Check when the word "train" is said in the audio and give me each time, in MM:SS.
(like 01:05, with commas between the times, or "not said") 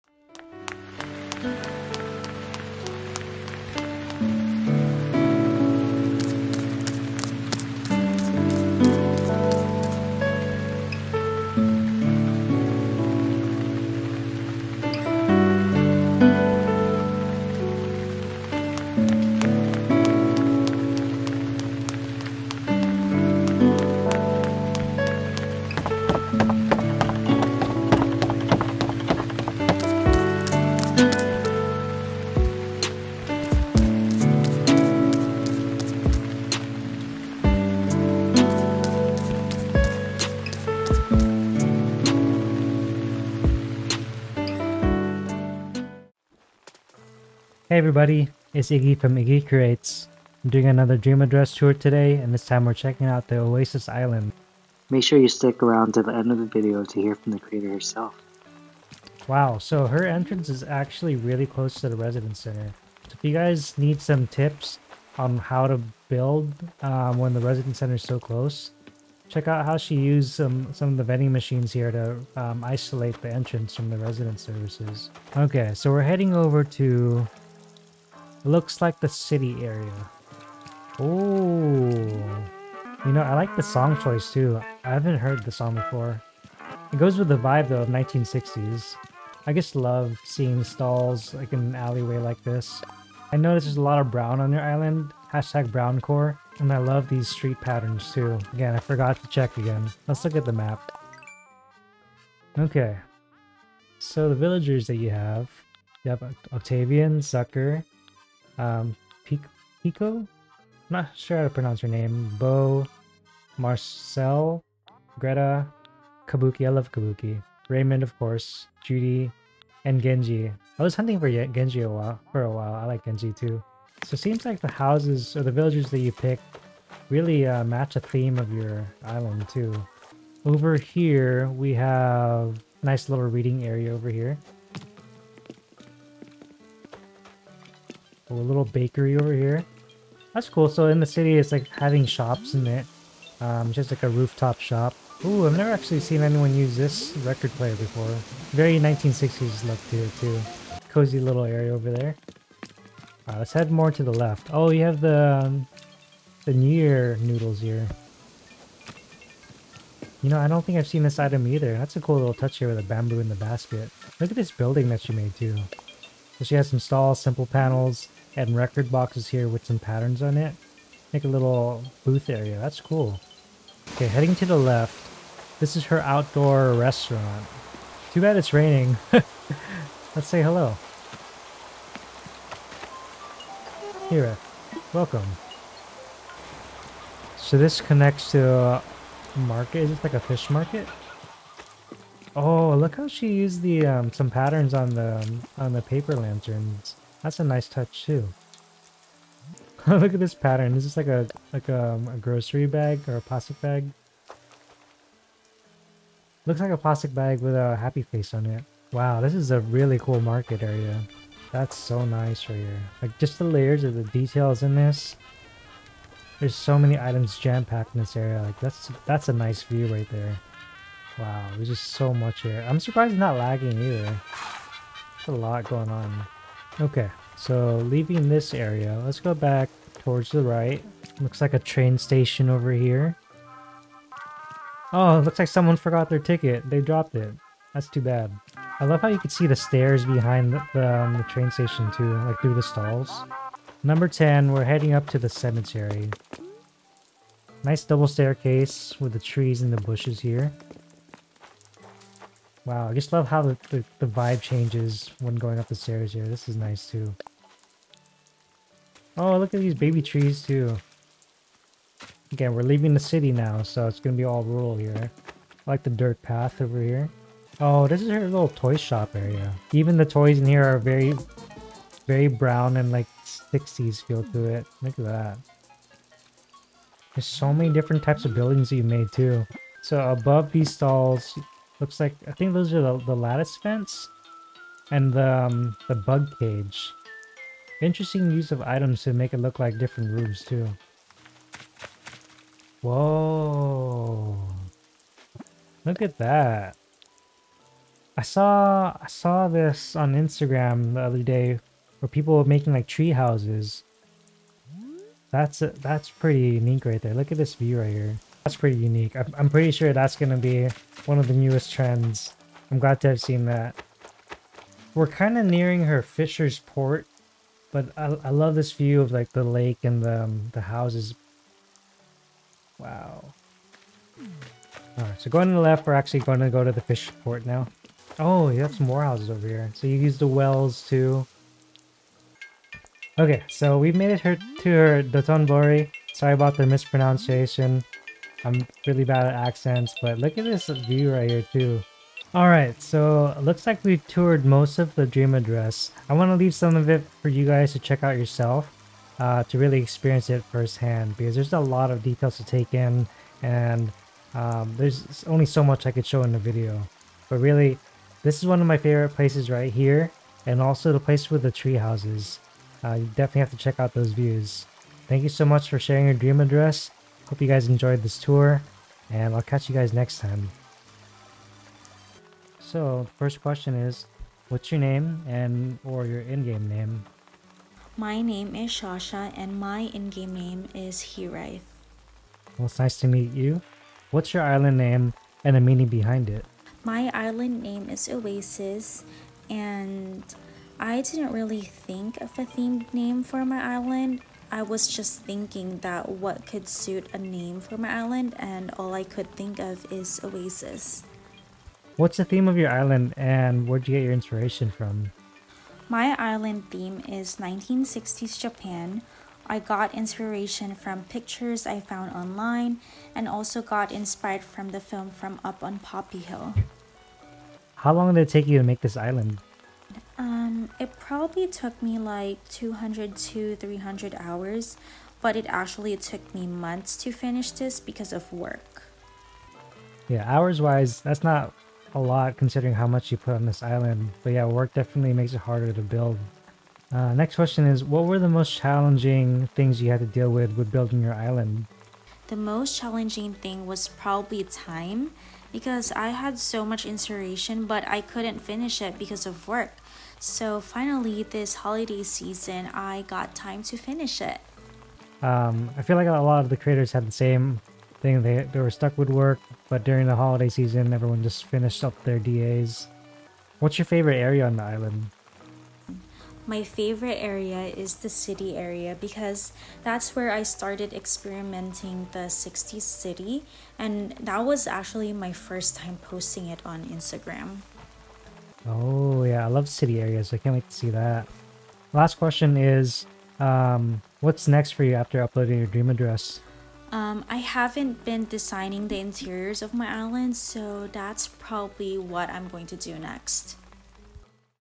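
03:51, 04:01.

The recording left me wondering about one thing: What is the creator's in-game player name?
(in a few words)
Hiraith.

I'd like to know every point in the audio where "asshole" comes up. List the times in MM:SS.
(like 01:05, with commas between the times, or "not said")
not said.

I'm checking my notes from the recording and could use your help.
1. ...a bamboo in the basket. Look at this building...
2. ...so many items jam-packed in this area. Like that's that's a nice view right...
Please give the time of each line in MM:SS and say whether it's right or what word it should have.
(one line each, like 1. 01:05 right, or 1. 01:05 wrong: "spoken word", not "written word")
1. 02:42 right
2. 03:36 right.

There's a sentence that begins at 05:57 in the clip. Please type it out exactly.
But really, this is one of my favorite places right here and also the place with the tree houses.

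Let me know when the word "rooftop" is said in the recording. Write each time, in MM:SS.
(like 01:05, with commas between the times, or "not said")
02:24.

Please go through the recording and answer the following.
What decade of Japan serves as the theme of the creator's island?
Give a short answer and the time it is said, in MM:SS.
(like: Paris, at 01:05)
1960s, at 06:47.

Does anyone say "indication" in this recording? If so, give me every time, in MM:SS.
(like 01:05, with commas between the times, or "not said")
not said.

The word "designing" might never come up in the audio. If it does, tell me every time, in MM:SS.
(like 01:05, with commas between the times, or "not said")
08:08.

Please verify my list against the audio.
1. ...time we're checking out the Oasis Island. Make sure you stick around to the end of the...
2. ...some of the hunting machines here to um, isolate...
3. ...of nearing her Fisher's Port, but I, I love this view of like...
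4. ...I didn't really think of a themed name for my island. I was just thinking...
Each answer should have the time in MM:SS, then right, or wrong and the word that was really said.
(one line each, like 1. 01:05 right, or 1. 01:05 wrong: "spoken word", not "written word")
1. 00:52 right
2. 01:10 wrong: "vending", not "hunting"
3. 05:15 right
4. 06:30 right.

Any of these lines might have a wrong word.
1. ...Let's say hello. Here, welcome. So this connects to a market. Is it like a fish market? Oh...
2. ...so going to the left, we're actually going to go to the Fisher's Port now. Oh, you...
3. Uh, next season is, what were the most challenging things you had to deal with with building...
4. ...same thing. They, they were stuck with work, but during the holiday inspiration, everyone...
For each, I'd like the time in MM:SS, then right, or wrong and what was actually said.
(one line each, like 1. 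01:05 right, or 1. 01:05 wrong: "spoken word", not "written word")
1. 03:00 right
2. 05:25 right
3. 07:16 wrong: "question", not "season"
4. 07:37 wrong: "season", not "inspiration".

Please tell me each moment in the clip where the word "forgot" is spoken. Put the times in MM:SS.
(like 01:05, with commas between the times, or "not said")
01:38, 03:55.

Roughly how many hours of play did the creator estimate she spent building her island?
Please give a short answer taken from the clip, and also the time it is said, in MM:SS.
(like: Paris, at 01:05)
200 to 300 hours, at 07:02.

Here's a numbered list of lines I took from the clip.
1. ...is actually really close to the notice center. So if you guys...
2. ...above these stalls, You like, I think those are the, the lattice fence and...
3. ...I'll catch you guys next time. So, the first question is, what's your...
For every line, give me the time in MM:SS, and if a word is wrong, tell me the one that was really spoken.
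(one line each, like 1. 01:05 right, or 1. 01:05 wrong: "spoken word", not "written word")
1. 01:00 wrong: "residence", not "notice"
2. 04:40 wrong: "Looks", not "You"
3. 06:09 right.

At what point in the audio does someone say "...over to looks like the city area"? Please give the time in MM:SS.
01:16.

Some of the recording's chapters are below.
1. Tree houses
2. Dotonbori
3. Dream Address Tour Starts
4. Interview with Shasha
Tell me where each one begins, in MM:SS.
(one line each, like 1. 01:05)
1. 04:55
2. 05:33
3. 00:45
4. 06:11.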